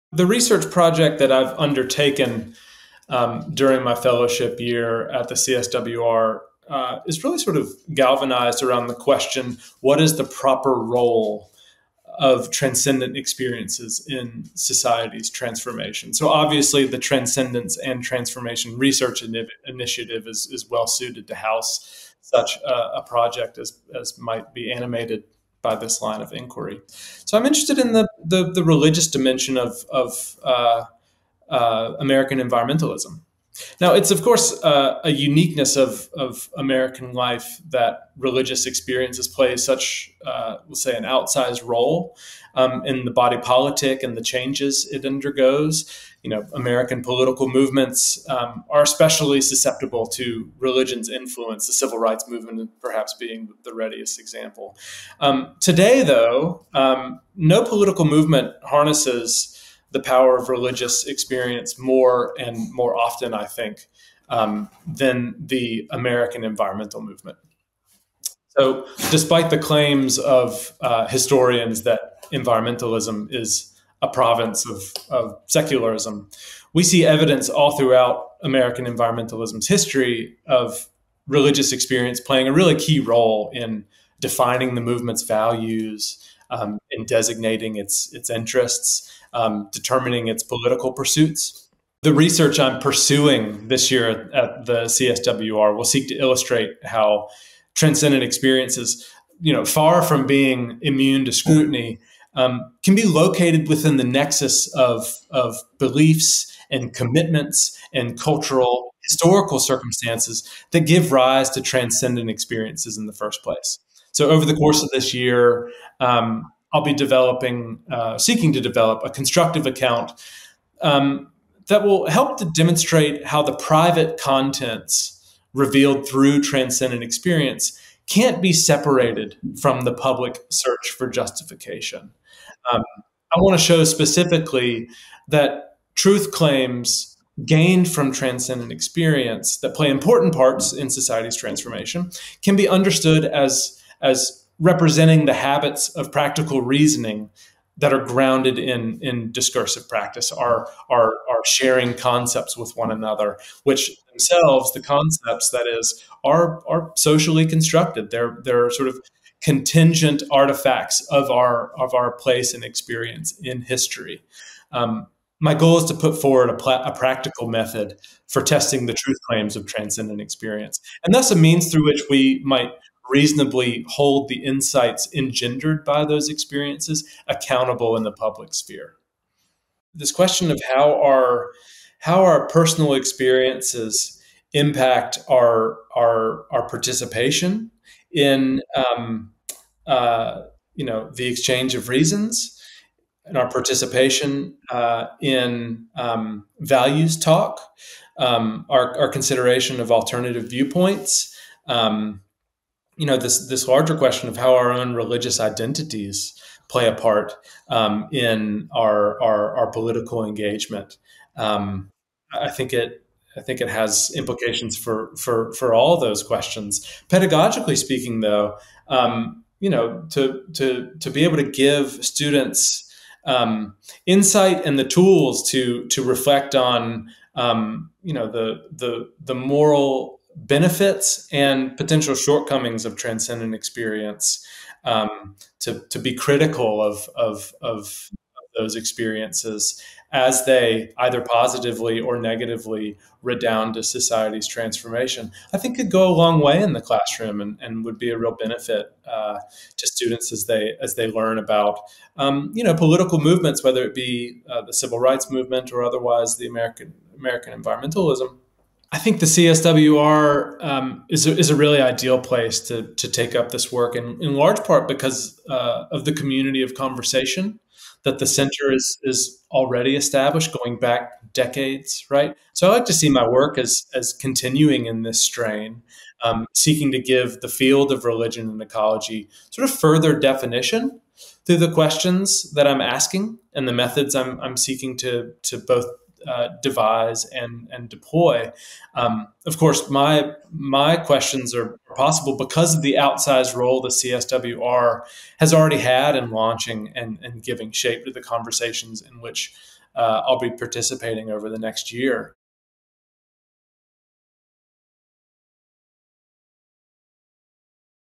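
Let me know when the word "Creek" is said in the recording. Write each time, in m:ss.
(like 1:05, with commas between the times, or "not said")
not said.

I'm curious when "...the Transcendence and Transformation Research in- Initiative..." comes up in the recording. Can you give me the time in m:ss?
0:16.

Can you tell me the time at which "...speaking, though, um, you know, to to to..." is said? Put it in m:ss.
3:37.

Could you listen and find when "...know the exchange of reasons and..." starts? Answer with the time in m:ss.
3:10.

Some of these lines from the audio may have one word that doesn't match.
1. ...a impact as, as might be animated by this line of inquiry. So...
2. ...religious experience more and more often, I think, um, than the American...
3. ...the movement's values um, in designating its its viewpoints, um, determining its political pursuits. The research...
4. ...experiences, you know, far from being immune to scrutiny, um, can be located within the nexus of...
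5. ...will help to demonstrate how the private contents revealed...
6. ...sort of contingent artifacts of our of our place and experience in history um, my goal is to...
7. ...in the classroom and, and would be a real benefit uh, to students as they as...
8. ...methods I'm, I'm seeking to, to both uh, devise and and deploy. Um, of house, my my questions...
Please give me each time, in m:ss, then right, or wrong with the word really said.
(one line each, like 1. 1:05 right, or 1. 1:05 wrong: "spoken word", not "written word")
1. 0:22 wrong: "project", not "impact"
2. 1:00 right
3. 1:24 wrong: "interests", not "viewpoints"
4. 1:38 right
5. 2:01 right
6. 2:38 right
7. 4:06 right
8. 4:43 wrong: "course", not "house".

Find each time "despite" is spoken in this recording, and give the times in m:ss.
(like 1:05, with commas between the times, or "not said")
1:09.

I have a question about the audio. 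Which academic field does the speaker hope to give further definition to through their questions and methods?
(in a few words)
religion and ecology.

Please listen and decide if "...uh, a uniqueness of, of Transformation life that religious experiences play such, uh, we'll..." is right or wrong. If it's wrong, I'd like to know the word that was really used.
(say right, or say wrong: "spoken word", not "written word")
wrong: "American", not "Transformation".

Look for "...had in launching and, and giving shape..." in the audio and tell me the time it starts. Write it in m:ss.
4:55.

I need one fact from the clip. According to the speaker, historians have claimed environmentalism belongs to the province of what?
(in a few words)
secularism.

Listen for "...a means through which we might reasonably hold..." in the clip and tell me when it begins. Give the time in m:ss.
2:51.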